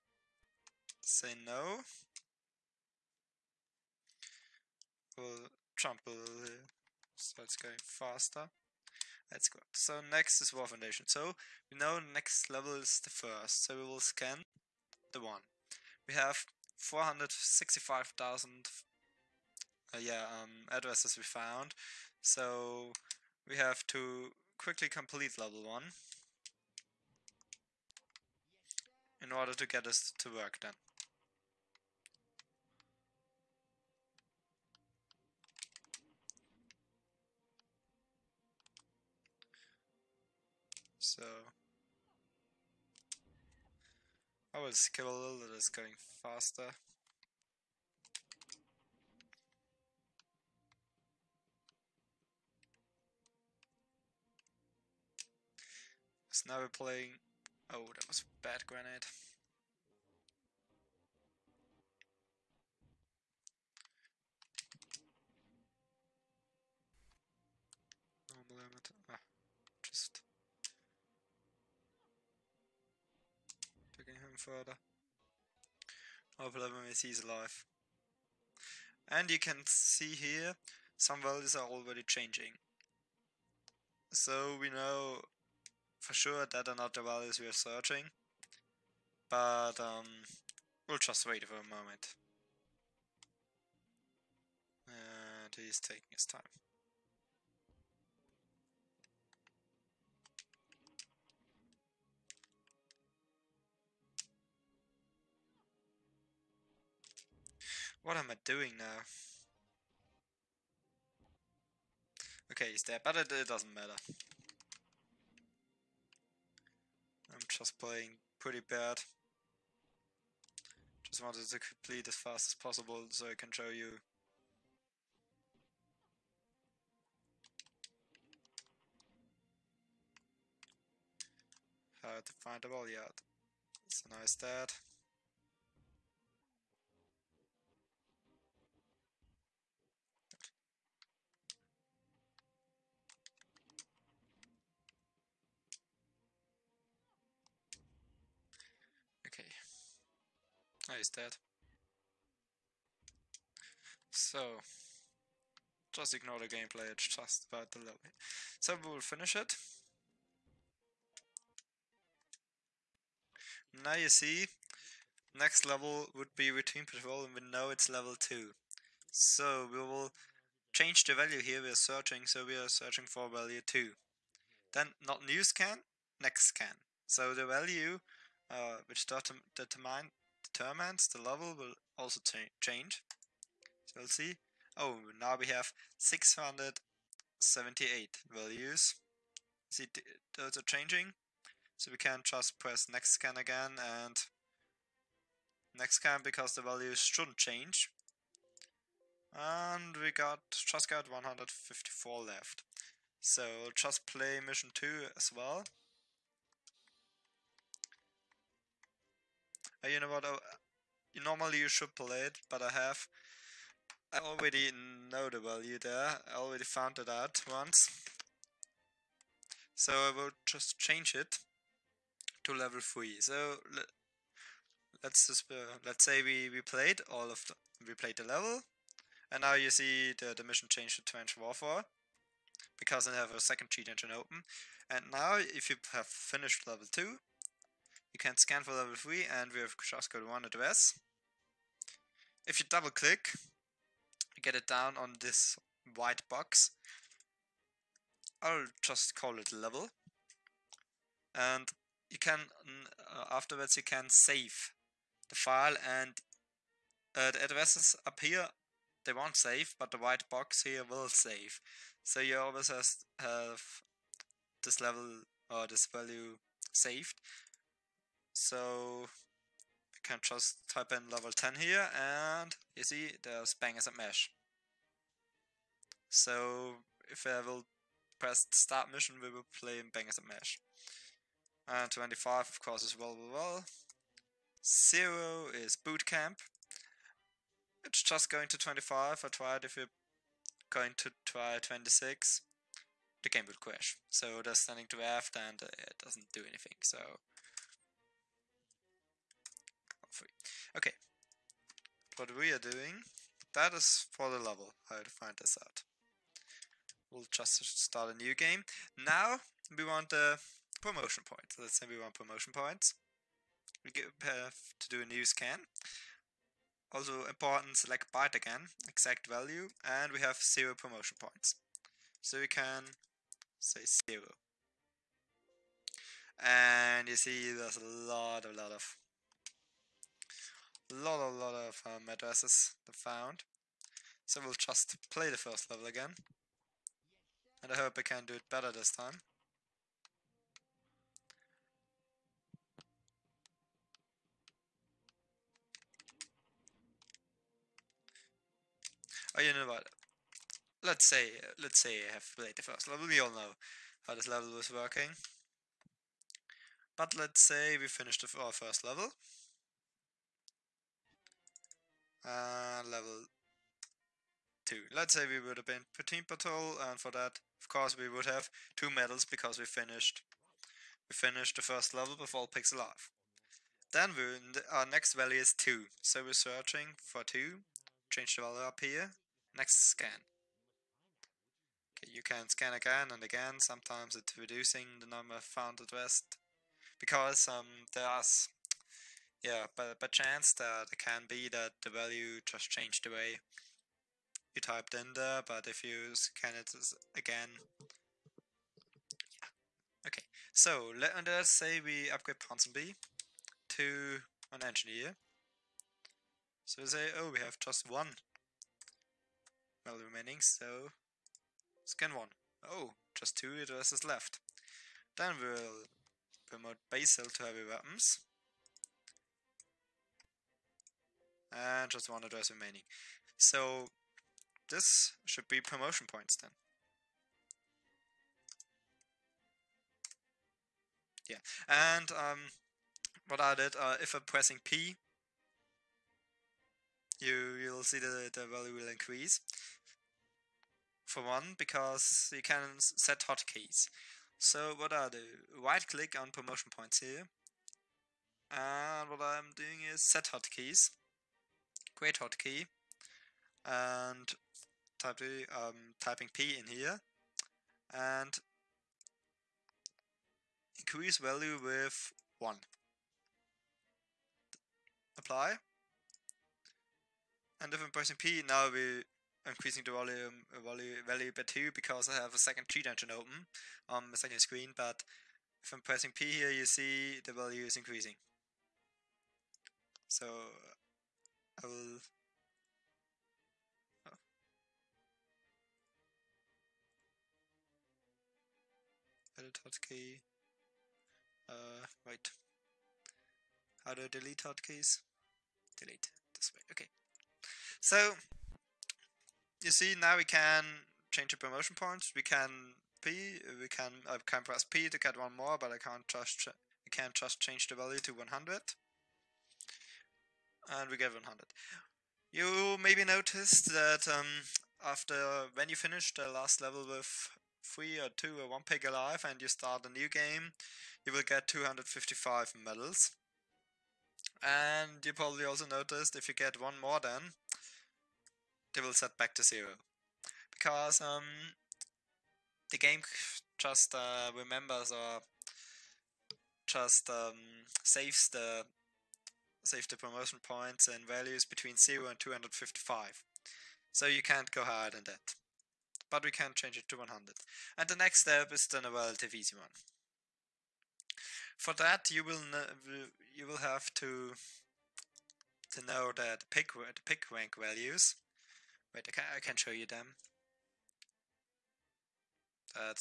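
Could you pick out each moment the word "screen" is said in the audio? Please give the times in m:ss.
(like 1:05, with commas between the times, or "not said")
7:54.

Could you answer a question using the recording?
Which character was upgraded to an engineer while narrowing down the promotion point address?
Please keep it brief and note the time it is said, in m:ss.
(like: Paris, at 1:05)
Ponsonby, at 6:42.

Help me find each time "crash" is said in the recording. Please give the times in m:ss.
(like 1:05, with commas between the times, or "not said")
4:53.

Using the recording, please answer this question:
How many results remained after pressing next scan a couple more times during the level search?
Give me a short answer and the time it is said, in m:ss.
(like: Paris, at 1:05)
154, at 3:21.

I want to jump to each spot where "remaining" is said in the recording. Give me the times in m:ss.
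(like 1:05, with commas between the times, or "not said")
6:49, 7:02.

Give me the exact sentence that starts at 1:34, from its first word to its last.
And uh, he's taking his time.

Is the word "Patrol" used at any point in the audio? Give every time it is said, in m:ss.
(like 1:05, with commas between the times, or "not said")
2:46, 6:06.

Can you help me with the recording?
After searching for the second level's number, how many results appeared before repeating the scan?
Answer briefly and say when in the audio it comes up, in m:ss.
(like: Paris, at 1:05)
678, at 3:05.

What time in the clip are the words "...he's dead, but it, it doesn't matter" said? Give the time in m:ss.
1:52.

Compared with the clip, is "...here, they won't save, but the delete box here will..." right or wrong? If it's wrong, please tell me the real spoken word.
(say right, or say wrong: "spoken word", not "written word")
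wrong: "white", not "delete".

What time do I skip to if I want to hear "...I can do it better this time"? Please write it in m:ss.
5:37.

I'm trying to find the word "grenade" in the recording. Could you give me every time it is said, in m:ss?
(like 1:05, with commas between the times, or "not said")
0:58.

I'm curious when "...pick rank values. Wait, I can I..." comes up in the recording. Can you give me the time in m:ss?
9:17.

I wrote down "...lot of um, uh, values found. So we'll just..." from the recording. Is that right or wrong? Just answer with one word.
wrong.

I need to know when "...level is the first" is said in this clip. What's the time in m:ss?
0:12.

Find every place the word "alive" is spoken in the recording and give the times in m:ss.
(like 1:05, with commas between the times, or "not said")
1:17, 6:12, 8:38.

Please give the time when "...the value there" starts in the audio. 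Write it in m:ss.
3:35.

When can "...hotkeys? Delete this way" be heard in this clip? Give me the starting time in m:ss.
8:14.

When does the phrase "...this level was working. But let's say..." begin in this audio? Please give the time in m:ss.
5:54.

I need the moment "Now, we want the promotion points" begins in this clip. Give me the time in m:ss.
5:08.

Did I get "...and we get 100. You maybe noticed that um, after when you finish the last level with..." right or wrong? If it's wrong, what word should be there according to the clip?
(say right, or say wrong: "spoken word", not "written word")
right.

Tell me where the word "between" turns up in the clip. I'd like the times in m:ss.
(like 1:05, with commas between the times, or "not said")
2:46, 9:01.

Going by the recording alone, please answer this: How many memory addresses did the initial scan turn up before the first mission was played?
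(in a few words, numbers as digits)
465,000.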